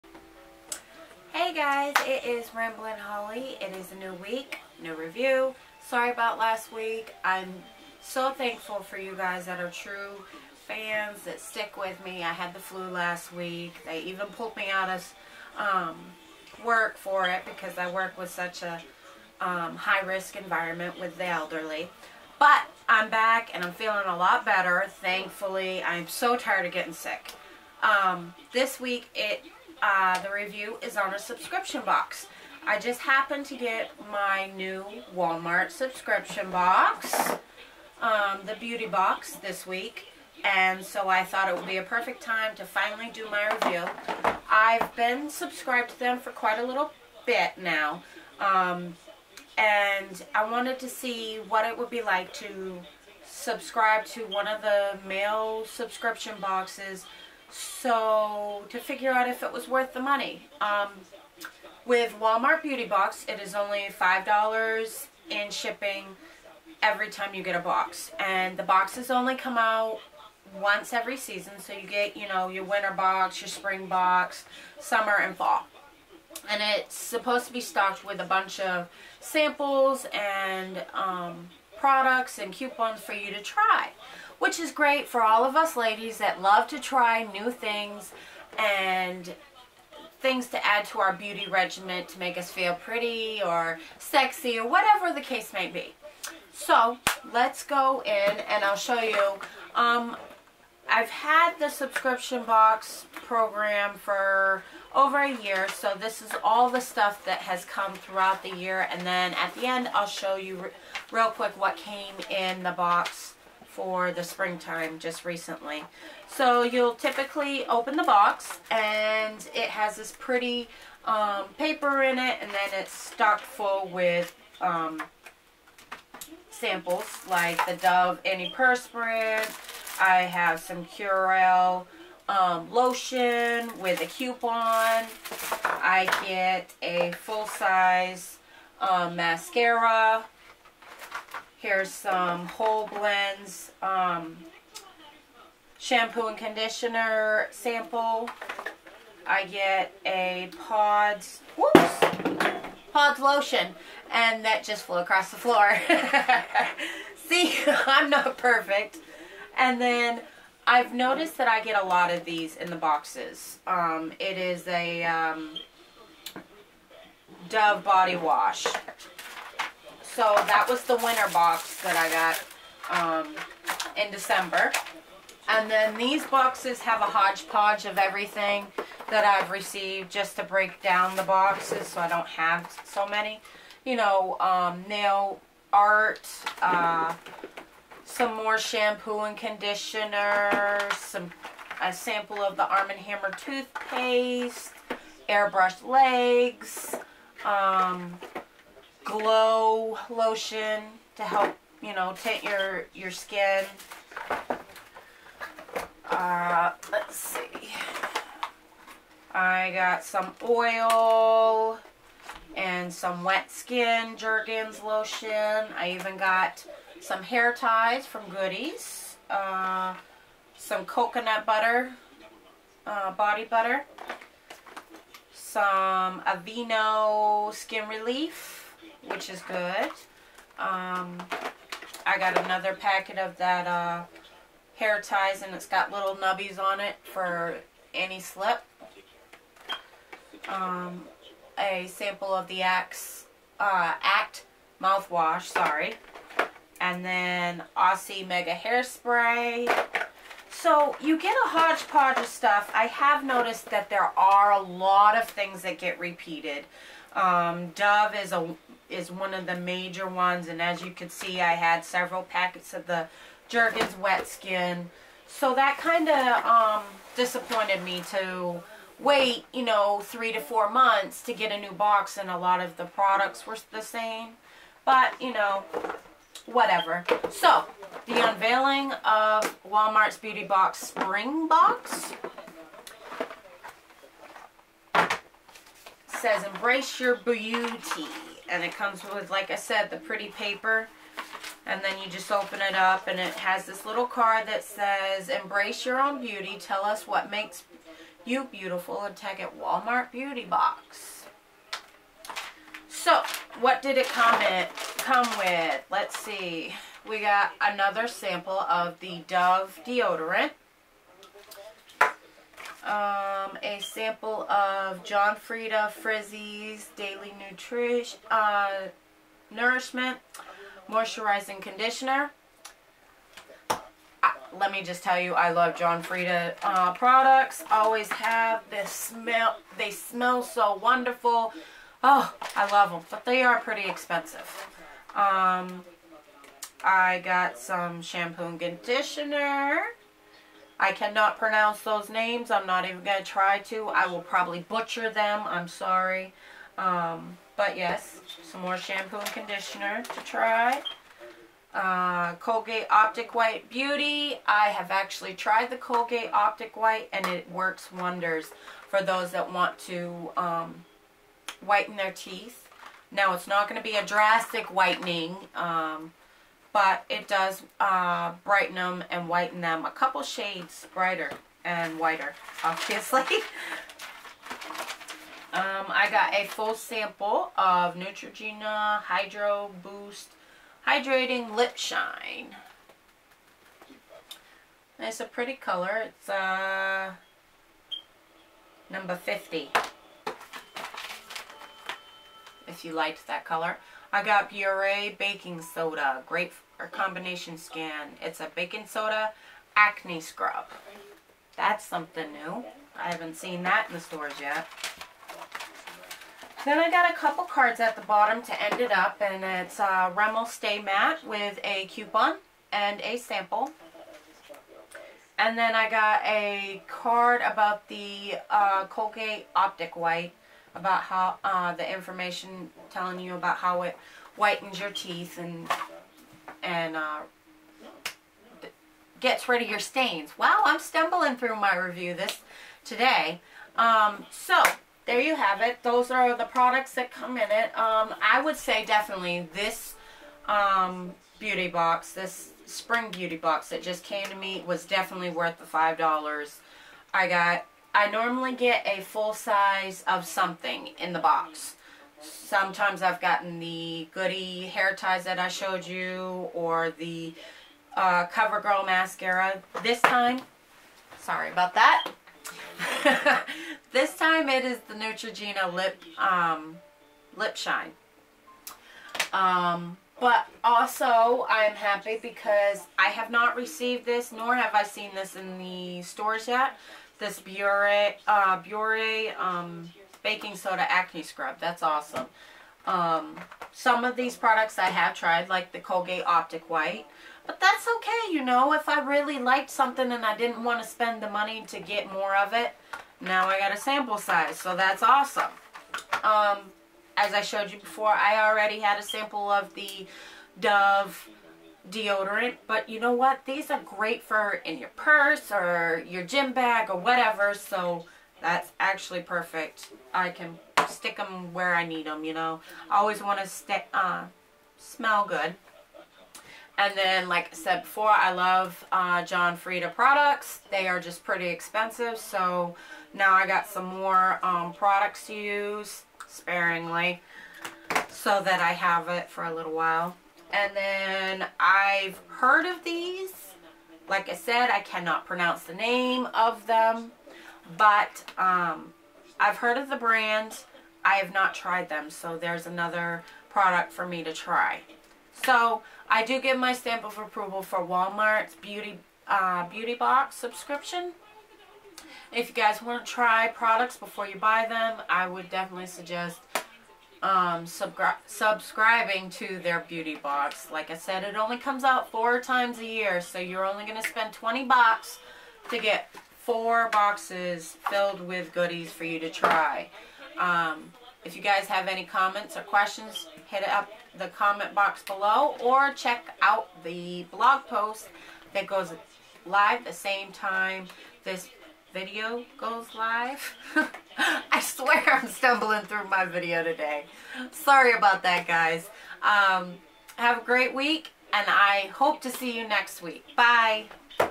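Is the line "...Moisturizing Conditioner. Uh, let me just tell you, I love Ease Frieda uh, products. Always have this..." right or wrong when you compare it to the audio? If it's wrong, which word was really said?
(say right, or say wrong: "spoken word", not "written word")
wrong: "John", not "Ease".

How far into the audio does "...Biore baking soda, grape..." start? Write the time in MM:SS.
06:34.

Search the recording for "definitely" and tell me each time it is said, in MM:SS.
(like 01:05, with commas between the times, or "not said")
07:18, 07:24, 09:15.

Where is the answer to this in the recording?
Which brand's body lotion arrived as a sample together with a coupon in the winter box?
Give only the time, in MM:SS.
02:10.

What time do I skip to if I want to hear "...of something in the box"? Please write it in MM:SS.
07:30.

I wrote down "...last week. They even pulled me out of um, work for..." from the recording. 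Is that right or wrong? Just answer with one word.
right.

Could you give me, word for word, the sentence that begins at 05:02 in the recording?
So, what did it come, in, come with?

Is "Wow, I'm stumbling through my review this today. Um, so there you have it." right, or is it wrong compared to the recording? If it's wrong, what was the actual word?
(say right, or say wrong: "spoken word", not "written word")
right.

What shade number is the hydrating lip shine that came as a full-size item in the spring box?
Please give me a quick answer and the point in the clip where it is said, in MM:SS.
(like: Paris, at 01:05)
50, at 06:29.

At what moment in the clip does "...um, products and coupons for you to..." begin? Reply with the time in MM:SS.
01:20.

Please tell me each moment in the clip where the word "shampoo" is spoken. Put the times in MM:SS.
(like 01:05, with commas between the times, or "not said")
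02:25, 03:08, 05:38, 05:48.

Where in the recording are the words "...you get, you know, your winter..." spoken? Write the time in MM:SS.
01:11.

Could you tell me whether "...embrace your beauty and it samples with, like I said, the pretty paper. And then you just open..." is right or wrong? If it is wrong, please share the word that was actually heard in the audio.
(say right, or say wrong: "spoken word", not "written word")
wrong: "comes", not "samples".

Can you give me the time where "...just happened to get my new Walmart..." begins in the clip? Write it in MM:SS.
00:32.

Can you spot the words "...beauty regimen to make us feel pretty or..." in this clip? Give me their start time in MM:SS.
01:31.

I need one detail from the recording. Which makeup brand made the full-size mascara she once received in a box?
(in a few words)
CoverGirl.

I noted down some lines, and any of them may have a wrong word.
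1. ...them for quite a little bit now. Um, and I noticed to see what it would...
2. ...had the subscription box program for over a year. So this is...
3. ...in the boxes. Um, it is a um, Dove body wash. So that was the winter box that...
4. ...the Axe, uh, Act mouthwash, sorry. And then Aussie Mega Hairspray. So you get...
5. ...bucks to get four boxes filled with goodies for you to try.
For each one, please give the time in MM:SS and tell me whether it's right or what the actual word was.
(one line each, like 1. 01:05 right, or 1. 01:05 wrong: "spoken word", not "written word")
1. 00:45 wrong: "wanted", not "noticed"
2. 01:41 right
3. 02:42 right
4. 04:02 right
5. 09:24 right.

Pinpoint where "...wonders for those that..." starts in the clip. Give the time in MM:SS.
05:57.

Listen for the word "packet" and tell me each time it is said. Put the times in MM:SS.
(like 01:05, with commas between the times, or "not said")
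03:52, 04:22.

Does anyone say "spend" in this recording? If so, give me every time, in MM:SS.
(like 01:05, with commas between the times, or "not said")
08:10, 09:24.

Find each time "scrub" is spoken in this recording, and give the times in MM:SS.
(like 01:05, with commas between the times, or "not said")
06:40, 08:01.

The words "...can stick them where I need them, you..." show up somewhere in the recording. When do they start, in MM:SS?
08:30.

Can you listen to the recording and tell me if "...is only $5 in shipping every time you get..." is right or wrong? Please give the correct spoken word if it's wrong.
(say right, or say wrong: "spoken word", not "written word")
right.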